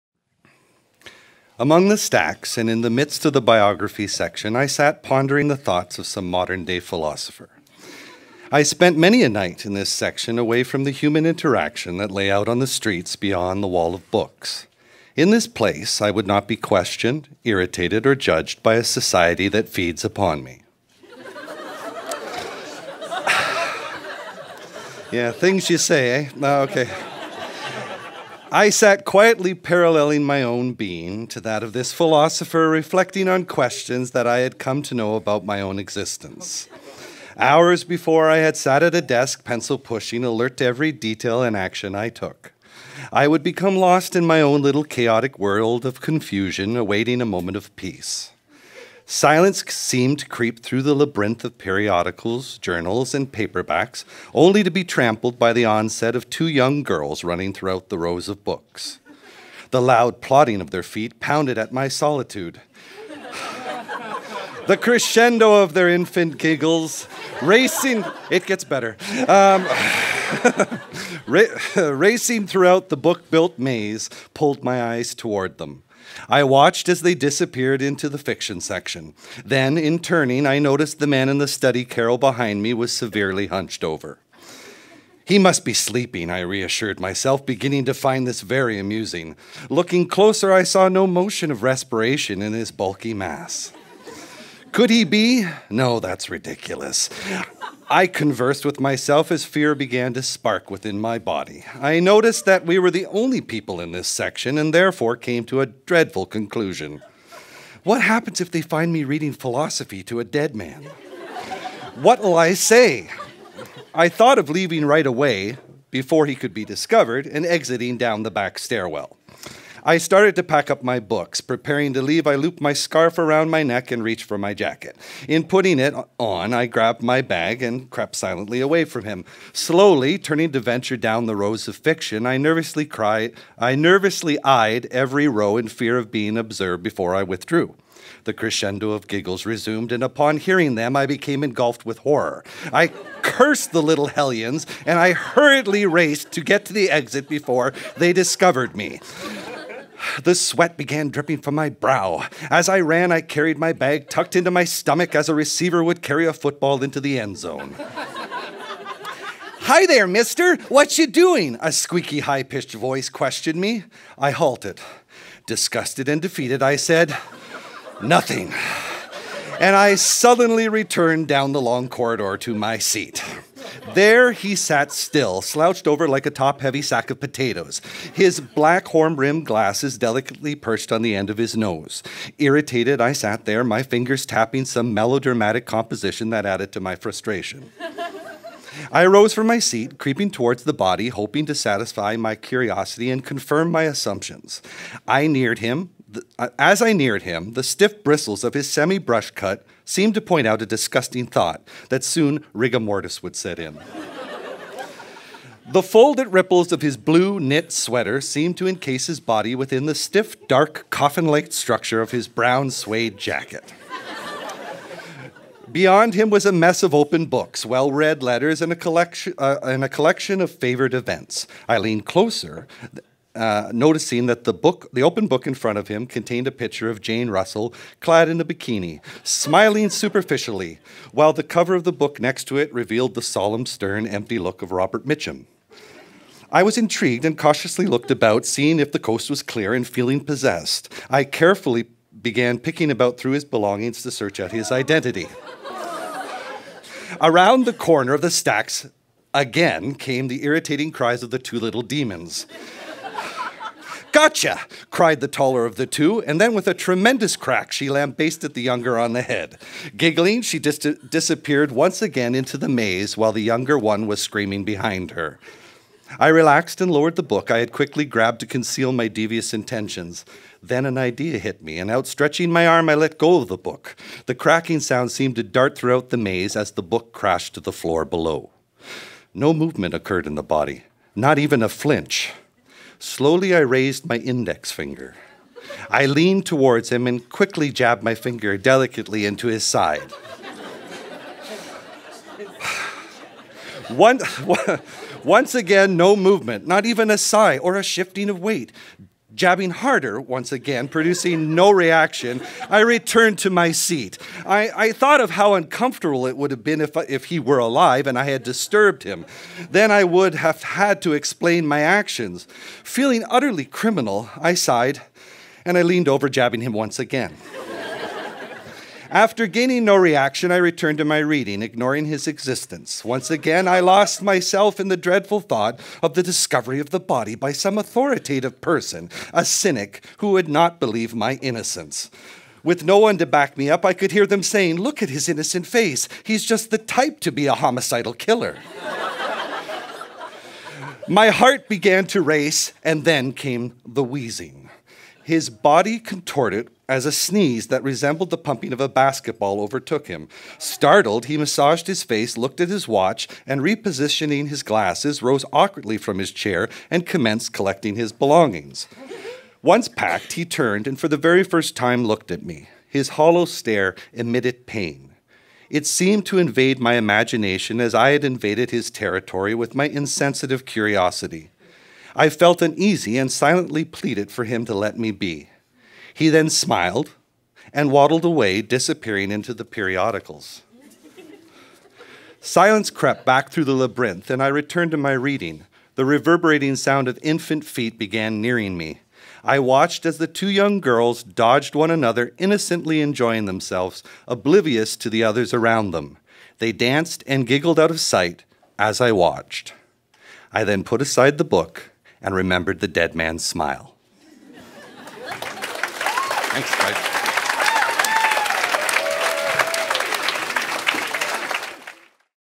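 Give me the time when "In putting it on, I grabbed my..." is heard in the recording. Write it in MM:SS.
02:05.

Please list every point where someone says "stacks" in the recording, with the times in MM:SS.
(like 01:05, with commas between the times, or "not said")
00:01, 04:08.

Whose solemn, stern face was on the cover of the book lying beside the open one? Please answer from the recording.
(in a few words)
Robert Mitchum.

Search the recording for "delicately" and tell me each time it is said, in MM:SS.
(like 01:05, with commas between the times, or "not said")
02:59, 04:48.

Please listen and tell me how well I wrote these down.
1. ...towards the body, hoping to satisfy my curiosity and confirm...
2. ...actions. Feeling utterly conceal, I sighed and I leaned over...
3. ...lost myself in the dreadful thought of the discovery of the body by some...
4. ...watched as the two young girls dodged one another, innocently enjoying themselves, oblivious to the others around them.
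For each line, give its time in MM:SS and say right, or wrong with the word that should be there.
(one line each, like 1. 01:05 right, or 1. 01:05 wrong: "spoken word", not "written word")
1. 03:10 right
2. 05:11 wrong: "criminal", not "conceal"
3. 05:23 right
4. 06:29 right.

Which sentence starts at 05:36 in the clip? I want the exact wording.
He's just the type to be a homicidal killer.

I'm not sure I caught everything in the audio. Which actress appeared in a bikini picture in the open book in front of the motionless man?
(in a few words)
Jane Russell.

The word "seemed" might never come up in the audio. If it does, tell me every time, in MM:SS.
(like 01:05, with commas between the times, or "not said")
00:49, 03:19, 03:28, 04:35, 06:05.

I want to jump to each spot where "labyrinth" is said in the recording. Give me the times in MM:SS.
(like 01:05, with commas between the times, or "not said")
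00:50, 06:23.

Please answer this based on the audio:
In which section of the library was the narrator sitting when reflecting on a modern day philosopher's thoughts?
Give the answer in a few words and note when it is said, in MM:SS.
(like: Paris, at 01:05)
Biography section, at 00:03.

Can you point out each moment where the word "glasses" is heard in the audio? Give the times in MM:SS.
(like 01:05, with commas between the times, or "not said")
02:59, 05:54.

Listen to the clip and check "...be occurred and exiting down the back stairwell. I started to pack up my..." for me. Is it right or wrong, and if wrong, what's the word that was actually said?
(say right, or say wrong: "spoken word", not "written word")
wrong: "discovered", not "occurred".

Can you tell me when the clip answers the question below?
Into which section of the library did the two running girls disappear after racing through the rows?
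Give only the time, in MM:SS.
01:18.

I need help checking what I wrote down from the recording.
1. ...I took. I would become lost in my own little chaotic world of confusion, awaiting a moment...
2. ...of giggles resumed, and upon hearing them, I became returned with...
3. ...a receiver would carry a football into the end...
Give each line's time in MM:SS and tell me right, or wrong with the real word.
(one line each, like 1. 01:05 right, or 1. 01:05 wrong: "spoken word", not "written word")
1. 00:41 right
2. 02:18 wrong: "engulfed", not "returned"
3. 02:35 right.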